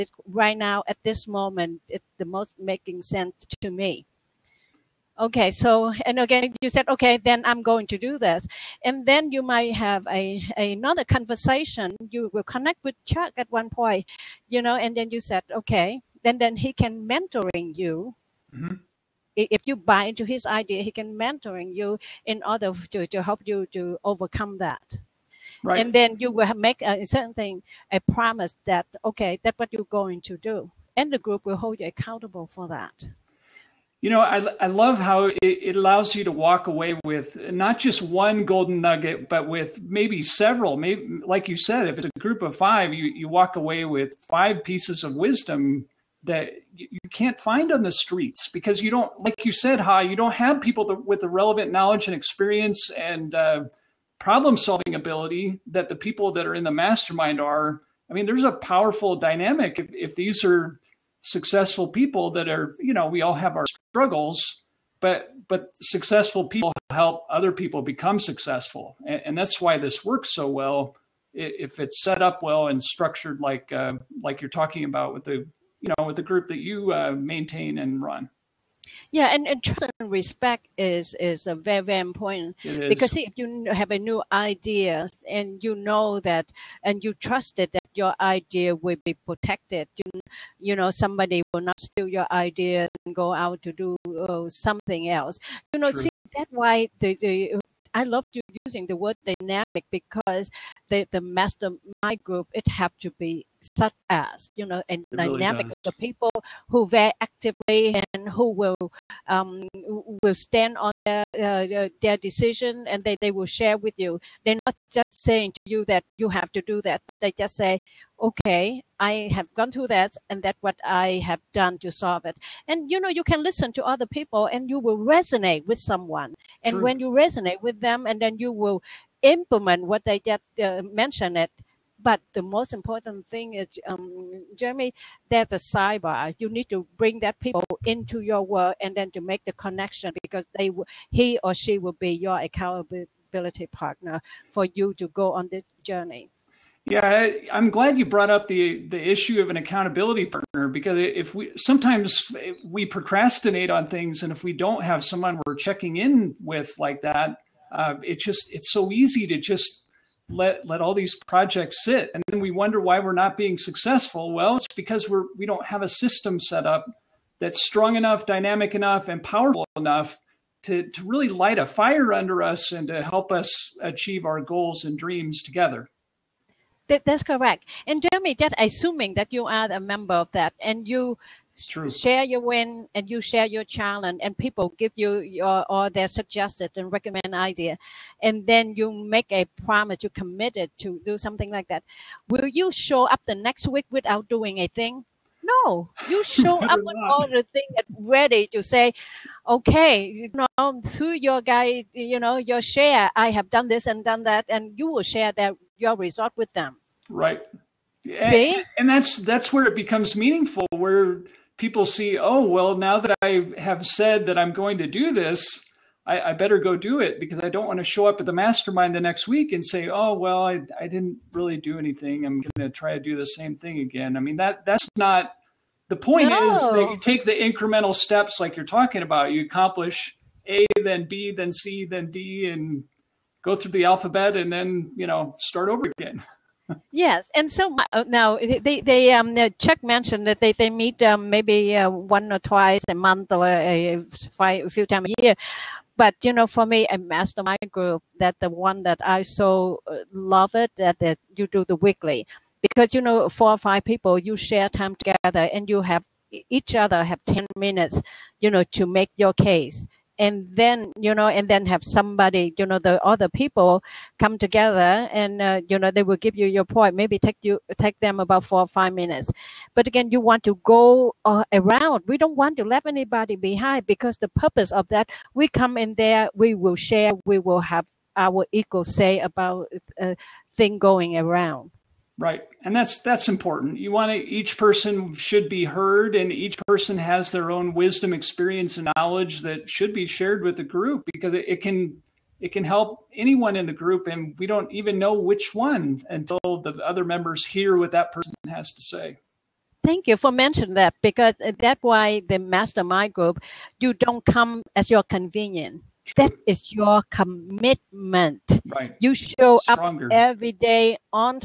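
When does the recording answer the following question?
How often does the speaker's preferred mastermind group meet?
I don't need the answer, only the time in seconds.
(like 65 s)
251 s.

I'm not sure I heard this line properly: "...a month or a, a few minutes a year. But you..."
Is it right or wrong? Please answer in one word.
wrong.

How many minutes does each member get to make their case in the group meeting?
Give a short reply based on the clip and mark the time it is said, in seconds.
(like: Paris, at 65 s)
10, at 257 s.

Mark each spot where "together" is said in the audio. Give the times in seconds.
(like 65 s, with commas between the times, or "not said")
175 s, 254 s, 264 s.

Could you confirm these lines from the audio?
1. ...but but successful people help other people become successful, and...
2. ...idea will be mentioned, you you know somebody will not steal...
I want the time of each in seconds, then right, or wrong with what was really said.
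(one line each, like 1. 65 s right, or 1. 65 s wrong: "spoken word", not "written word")
1. 64 s right
2. 88 s wrong: "protected", not "mentioned".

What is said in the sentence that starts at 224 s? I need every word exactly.
I mean, that that's not the point no.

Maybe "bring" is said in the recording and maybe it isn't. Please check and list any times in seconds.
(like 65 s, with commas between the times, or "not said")
136 s.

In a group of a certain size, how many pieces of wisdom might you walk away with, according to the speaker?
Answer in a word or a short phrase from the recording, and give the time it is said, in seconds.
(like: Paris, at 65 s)
5, at 44 s.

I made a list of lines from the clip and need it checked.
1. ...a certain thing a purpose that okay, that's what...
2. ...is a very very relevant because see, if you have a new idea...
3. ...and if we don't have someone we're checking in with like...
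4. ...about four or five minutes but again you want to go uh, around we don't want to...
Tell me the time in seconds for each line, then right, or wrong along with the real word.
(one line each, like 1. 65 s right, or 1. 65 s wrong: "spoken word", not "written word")
1. 26 s wrong: "promise", not "purpose"
2. 81 s wrong: "important", not "relevant"
3. 154 s right
4. 268 s right.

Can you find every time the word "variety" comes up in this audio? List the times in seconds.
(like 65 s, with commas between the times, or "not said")
not said.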